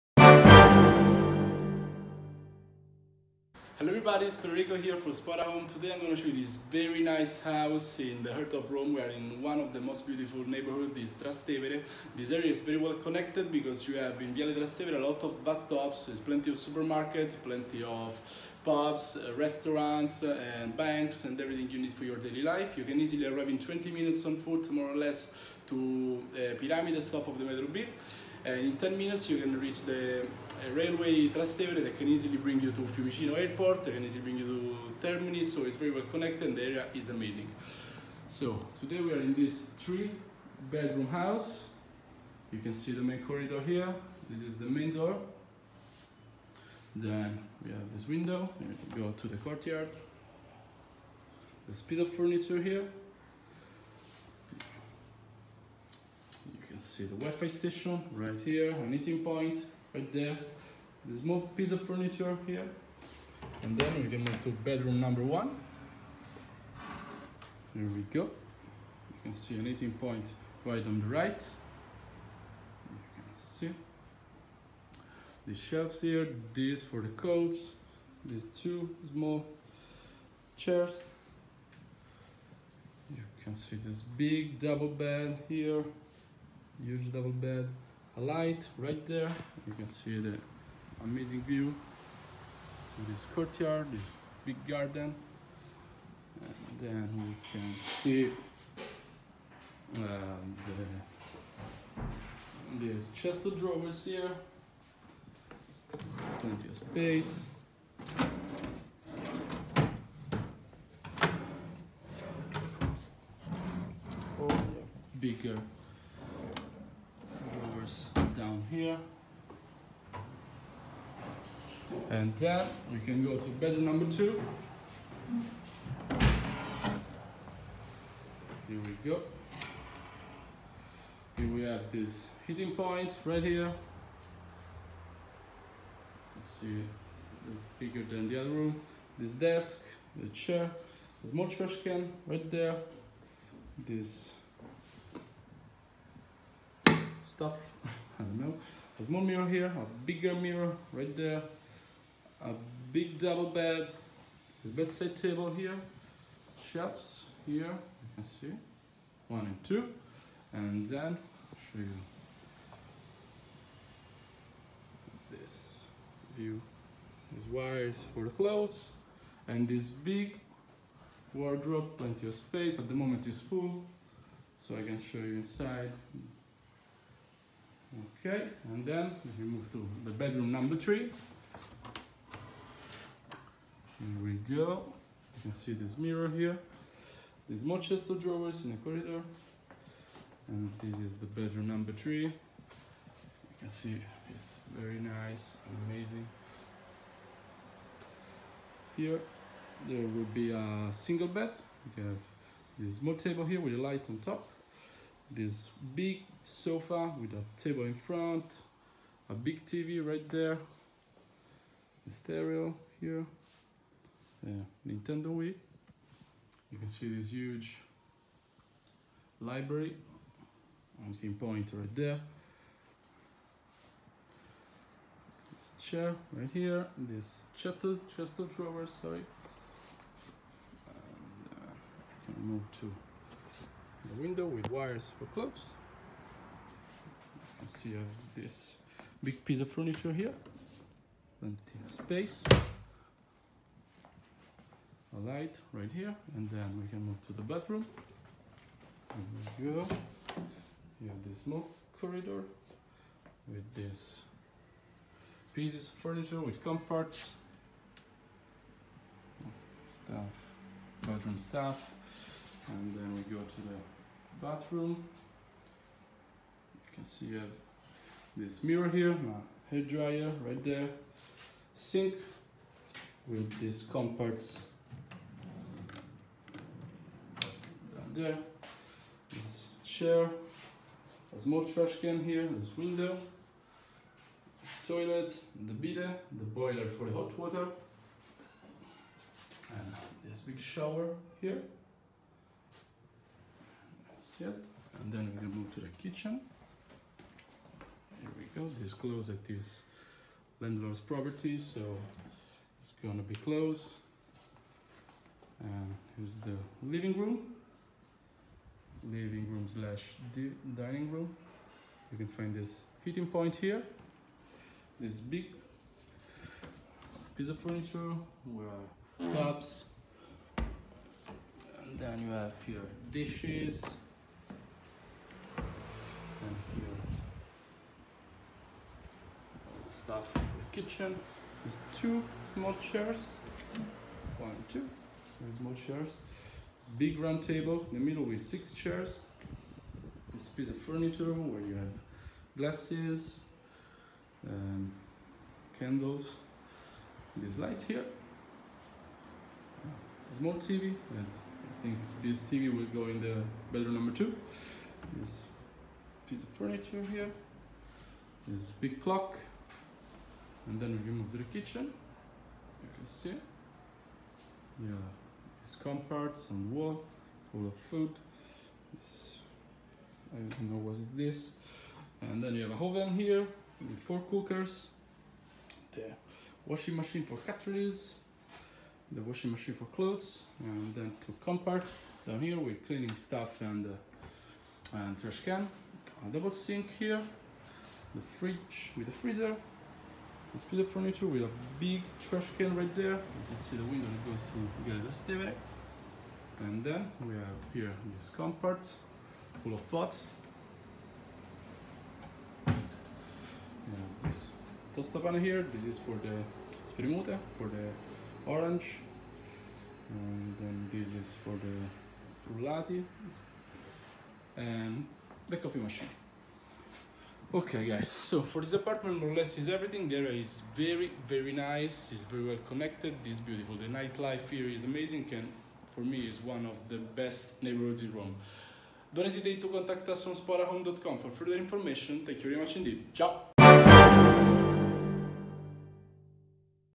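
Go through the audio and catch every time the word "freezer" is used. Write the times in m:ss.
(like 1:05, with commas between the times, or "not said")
6:29.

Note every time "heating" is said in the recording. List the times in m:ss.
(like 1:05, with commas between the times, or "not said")
2:12, 5:13.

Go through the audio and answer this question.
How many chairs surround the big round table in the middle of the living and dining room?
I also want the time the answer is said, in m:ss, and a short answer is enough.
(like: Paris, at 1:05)
6, at 5:38.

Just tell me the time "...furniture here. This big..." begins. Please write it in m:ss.
5:56.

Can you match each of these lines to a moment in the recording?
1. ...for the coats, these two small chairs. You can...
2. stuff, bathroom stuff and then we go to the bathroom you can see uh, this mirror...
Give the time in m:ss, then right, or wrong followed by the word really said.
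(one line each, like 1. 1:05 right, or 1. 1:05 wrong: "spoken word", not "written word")
1. 1:16 right
2. 4:20 right.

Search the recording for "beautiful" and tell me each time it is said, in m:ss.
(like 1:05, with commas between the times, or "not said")
0:10, 7:03.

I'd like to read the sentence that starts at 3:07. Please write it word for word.
There's more chest of drawers in the corridor.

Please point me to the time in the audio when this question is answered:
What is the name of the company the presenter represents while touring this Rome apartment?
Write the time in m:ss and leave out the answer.
0:05.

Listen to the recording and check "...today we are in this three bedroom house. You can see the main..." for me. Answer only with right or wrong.
right.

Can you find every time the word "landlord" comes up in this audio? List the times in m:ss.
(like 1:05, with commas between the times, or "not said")
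5:00.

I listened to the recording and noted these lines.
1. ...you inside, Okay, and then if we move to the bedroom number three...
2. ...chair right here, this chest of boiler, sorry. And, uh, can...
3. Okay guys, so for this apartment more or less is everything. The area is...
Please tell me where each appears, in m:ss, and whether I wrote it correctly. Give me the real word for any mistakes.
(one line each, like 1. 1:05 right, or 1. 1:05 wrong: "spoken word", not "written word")
1. 2:55 right
2. 3:45 wrong: "drawer", not "boiler"
3. 6:57 right.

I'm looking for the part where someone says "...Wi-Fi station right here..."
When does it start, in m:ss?
0:57.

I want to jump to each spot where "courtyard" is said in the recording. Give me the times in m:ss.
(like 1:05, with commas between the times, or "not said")
0:49, 1:33.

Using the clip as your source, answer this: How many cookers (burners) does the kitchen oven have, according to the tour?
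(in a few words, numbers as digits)
4.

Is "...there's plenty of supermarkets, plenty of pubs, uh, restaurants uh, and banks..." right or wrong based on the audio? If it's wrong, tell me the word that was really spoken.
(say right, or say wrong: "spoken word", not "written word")
right.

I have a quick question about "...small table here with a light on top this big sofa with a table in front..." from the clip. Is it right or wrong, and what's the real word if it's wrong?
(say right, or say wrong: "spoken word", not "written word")
right.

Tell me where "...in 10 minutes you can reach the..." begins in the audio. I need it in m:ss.
0:28.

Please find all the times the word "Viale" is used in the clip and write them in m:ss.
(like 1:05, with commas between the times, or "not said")
0:14.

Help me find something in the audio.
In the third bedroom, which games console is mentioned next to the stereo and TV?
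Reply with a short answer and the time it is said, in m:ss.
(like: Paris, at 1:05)
Nintendo Wii, at 3:34.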